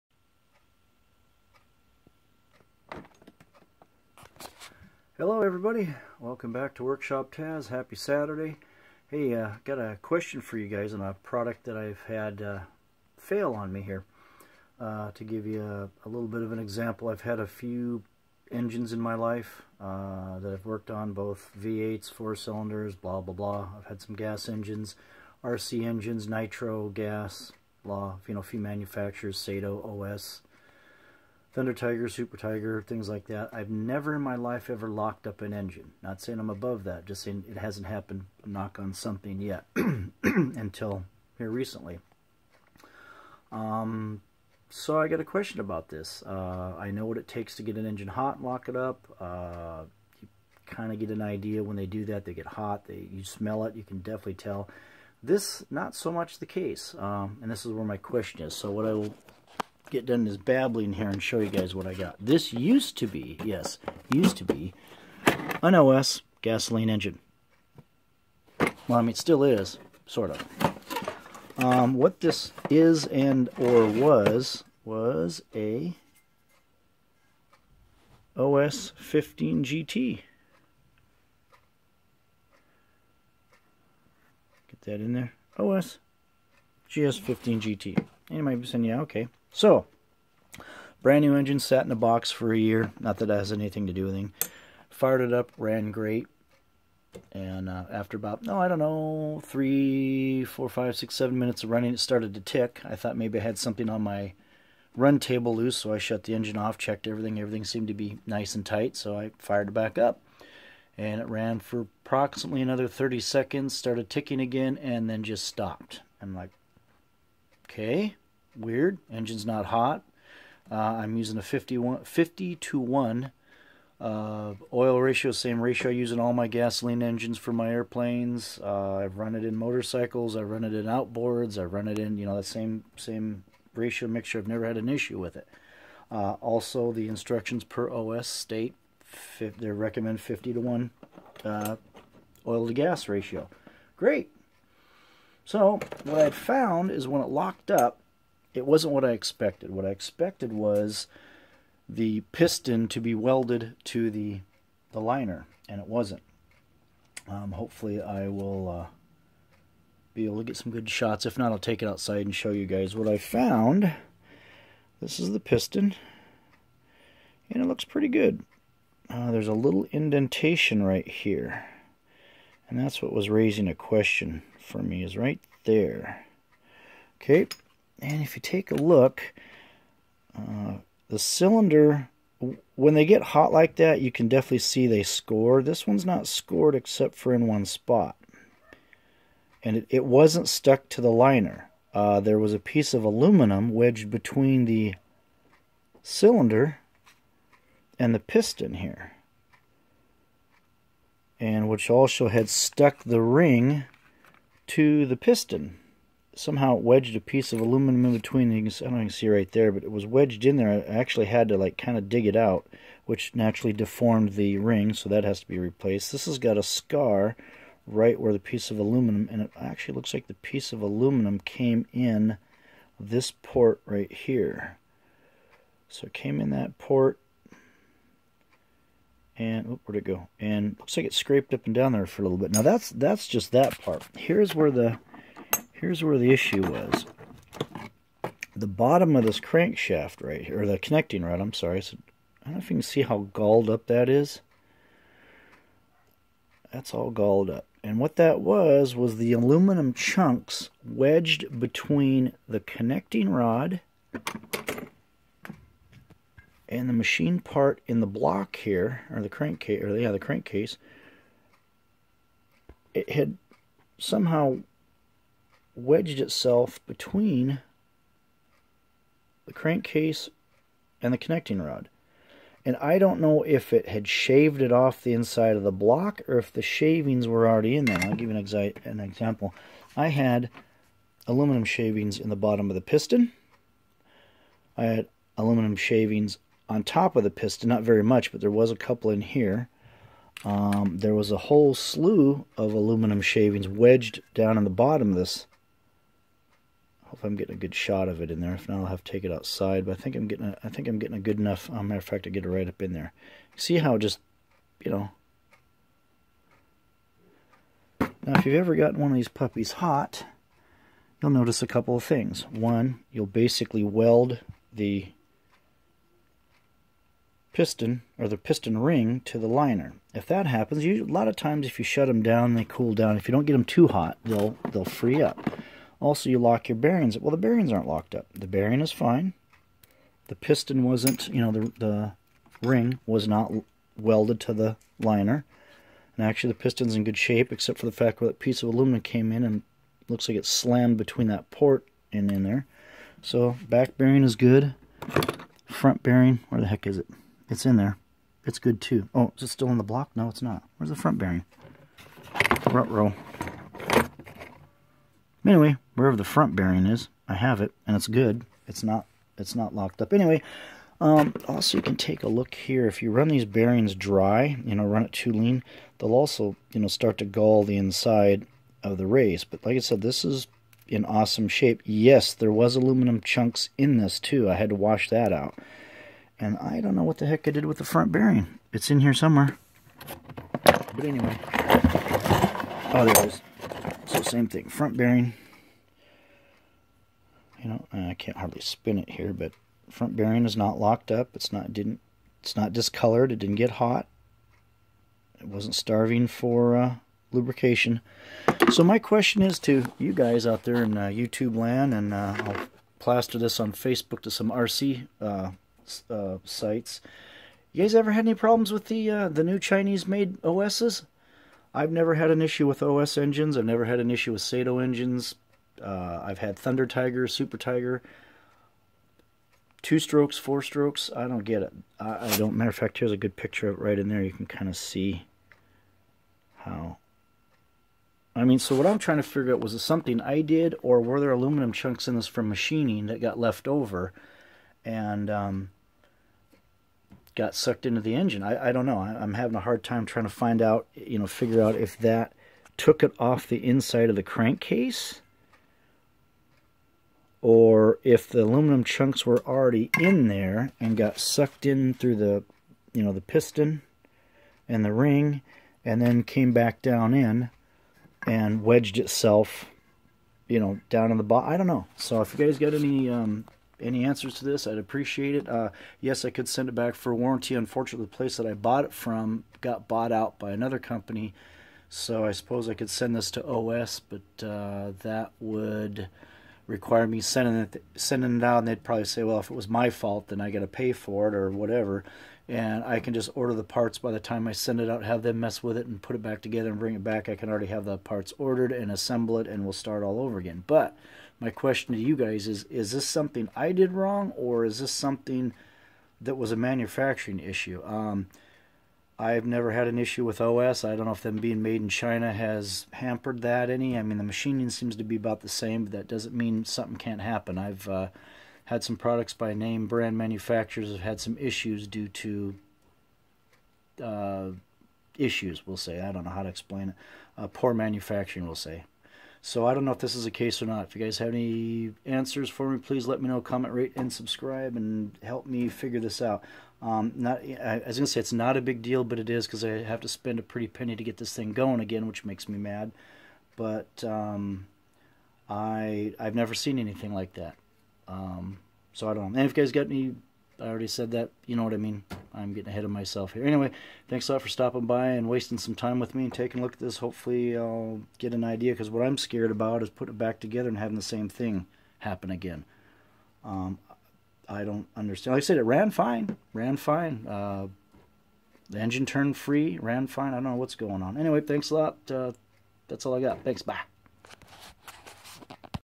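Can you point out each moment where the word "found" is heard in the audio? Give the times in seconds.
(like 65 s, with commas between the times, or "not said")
146 s, 163 s.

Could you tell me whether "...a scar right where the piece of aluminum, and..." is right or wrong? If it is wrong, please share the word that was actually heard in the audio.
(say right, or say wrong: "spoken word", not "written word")
right.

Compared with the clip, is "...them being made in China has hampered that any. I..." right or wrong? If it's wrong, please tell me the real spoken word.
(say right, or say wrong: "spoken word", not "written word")
right.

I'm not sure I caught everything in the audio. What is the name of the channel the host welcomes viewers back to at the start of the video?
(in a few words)
Workshop Tazz.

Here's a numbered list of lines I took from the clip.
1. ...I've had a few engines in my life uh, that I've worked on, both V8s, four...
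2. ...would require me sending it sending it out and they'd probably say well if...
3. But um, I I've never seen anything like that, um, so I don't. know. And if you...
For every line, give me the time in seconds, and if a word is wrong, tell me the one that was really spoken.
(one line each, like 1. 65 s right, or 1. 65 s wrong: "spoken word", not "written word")
1. 17 s right
2. 475 s right
3. 533 s right.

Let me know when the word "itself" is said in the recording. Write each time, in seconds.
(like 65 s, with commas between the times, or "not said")
266 s, 458 s.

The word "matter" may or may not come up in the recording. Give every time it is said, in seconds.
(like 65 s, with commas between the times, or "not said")
301 s, 422 s.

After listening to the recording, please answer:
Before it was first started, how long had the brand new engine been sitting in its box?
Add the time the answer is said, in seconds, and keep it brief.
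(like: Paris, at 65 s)
a year, at 92 s.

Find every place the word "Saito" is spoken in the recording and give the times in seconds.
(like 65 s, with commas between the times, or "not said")
29 s, 414 s.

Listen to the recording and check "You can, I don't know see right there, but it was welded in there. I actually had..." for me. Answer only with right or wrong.
wrong.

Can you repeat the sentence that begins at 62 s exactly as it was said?
This used to be, yes, used to be an OS gasoline engine.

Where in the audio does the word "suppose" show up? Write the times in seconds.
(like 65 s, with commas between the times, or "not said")
472 s.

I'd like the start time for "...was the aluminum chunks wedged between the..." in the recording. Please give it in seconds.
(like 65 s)
248 s.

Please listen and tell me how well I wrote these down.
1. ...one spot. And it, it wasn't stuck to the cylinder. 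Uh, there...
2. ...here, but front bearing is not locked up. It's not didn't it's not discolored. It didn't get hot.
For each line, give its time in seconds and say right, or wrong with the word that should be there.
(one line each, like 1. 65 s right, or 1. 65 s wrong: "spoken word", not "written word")
1. 187 s wrong: "liner", not "cylinder"
2. 389 s right.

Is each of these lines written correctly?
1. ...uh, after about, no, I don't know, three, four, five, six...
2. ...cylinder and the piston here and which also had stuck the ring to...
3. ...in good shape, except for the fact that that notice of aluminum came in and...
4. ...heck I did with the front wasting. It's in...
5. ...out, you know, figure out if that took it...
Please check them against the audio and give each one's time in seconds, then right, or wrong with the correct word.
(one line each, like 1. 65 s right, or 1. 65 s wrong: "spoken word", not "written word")
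1. 97 s right
2. 196 s right
3. 336 s wrong: "piece", not "notice"
4. 377 s wrong: "bearing", not "wasting"
5. 440 s right.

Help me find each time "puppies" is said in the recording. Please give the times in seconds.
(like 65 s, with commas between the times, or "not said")
309 s.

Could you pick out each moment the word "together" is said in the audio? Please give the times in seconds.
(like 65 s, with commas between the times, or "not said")
486 s, 550 s.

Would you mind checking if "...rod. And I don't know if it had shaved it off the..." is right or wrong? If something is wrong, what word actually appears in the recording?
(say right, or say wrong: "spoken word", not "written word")
right.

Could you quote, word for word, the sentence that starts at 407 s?
You guys ever had any problems with the uh, the new Chinese-made OSs?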